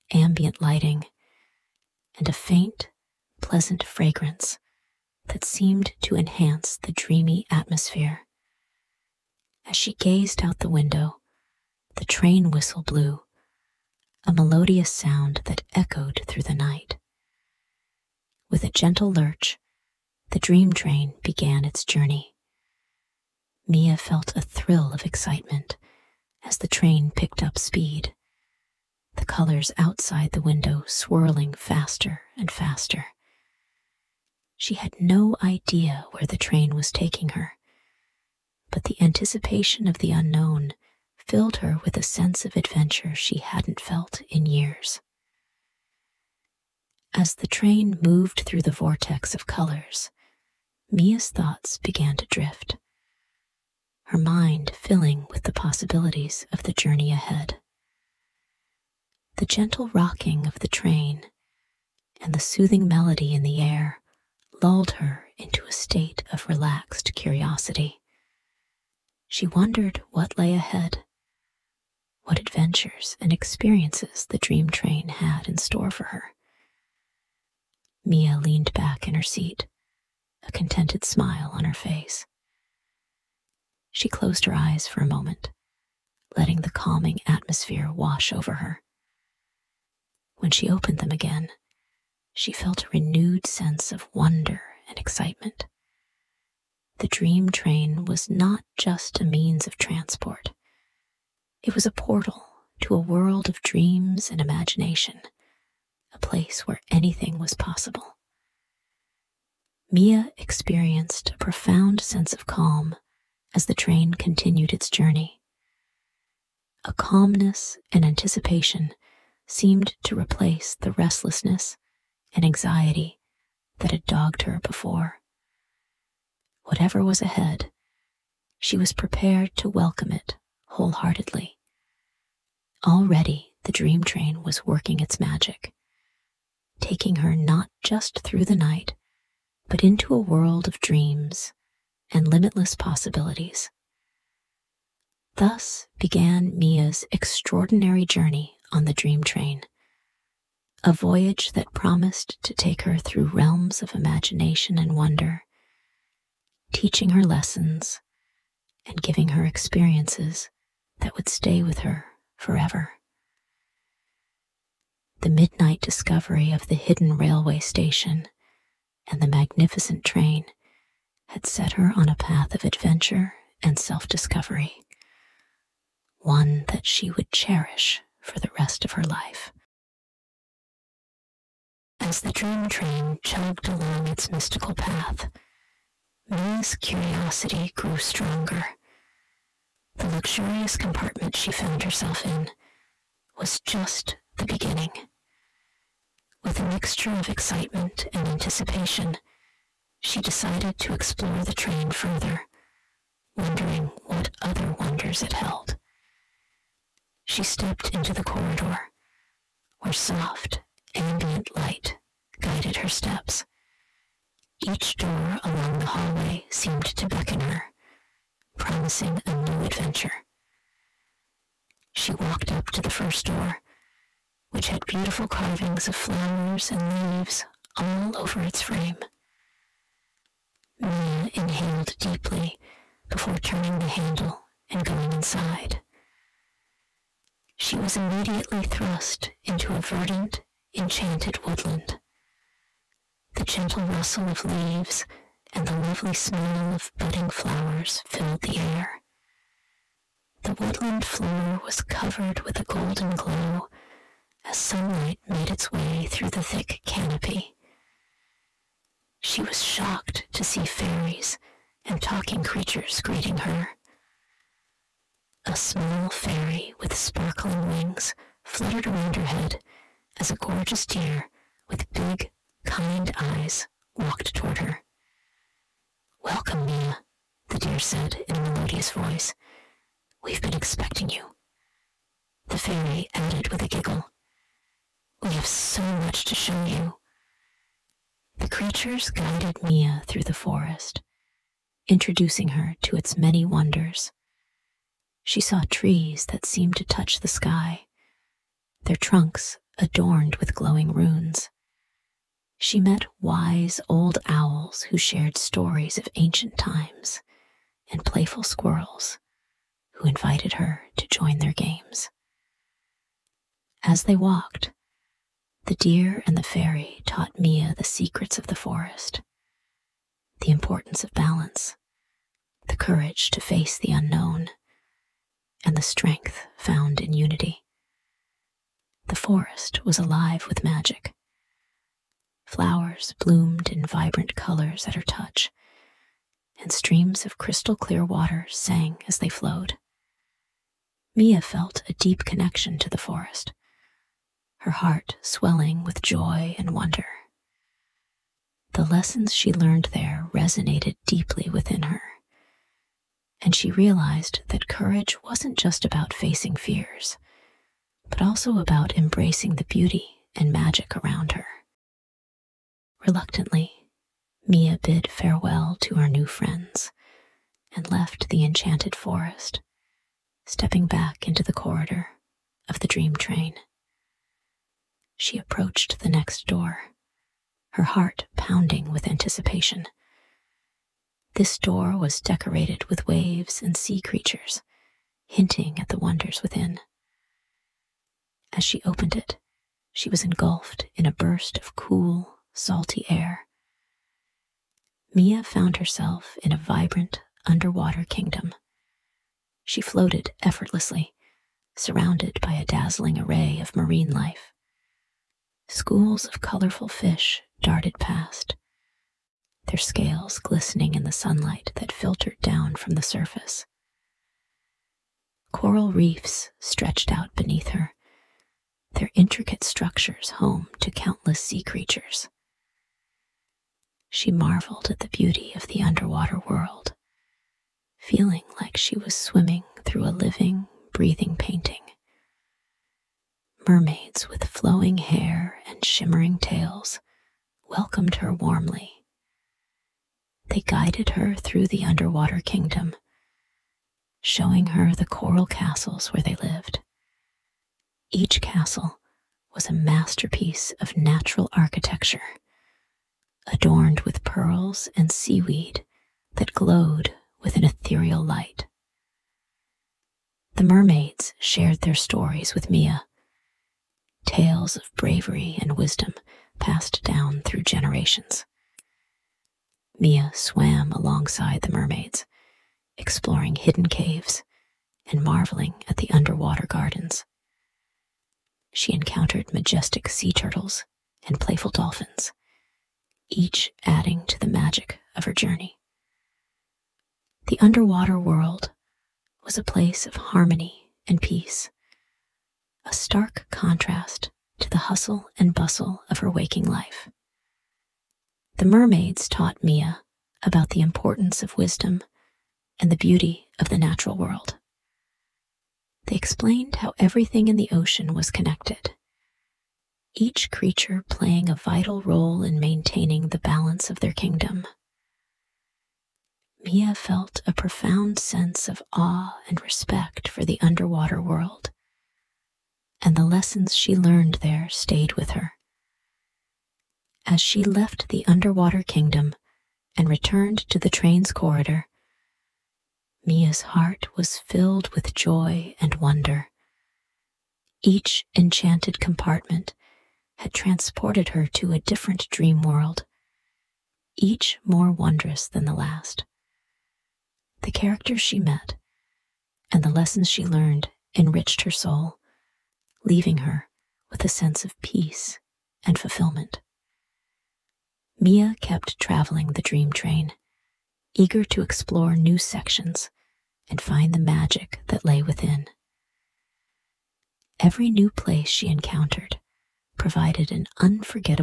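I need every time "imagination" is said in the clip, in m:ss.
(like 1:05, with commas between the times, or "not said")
1:44, 2:33.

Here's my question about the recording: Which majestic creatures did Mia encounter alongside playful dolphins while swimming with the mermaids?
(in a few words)
Sea turtles.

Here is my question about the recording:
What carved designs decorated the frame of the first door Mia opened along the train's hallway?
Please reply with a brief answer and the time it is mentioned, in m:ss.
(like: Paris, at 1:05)
Flowers and leaves, at 3:45.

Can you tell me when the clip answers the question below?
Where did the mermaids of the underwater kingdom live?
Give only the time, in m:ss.
7:25.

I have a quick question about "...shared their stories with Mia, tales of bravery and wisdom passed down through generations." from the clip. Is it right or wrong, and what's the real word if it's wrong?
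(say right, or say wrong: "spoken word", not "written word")
right.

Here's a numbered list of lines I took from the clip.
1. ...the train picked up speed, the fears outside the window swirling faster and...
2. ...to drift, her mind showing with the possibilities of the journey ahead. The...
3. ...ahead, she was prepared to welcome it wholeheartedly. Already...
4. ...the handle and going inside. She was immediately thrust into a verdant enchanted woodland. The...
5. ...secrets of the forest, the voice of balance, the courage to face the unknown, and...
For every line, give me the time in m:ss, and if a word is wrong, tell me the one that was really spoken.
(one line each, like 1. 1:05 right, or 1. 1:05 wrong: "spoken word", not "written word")
1. 0:26 wrong: "colors", not "fears"
2. 0:52 wrong: "filling", not "showing"
3. 2:07 right
4. 3:53 right
5. 5:17 wrong: "importance", not "voice".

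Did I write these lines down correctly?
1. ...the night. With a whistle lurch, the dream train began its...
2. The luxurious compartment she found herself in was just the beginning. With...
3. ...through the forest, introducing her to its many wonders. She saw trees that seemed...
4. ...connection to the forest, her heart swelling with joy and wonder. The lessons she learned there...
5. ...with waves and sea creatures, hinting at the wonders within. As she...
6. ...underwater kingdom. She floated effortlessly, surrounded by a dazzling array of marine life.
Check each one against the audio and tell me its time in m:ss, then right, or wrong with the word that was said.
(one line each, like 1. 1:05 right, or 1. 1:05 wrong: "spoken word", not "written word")
1. 0:16 wrong: "gentle", not "whistle"
2. 3:09 right
3. 4:50 right
4. 5:42 right
5. 6:22 right
6. 6:37 right.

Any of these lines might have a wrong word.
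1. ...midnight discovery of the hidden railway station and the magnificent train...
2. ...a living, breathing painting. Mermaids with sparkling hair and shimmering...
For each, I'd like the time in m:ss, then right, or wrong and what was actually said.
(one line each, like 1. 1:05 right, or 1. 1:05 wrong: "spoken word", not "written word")
1. 2:45 right
2. 7:10 wrong: "flowing", not "sparkling".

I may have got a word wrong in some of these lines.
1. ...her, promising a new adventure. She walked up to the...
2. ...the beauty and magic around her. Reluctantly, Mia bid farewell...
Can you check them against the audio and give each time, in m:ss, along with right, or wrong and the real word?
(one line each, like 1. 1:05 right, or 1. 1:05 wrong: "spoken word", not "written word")
1. 3:37 right
2. 5:59 right.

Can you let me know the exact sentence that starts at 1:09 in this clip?
She wondered what lay ahead, what adventures and experiences the dream train had in store for her.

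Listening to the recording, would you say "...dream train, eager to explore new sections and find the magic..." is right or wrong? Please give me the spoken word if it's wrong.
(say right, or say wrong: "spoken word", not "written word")
right.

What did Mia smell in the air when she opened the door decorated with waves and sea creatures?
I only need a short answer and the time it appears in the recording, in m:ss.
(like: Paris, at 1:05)
Cool, salty air, at 6:31.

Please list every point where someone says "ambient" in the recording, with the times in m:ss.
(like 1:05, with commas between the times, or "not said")
0:00, 3:30.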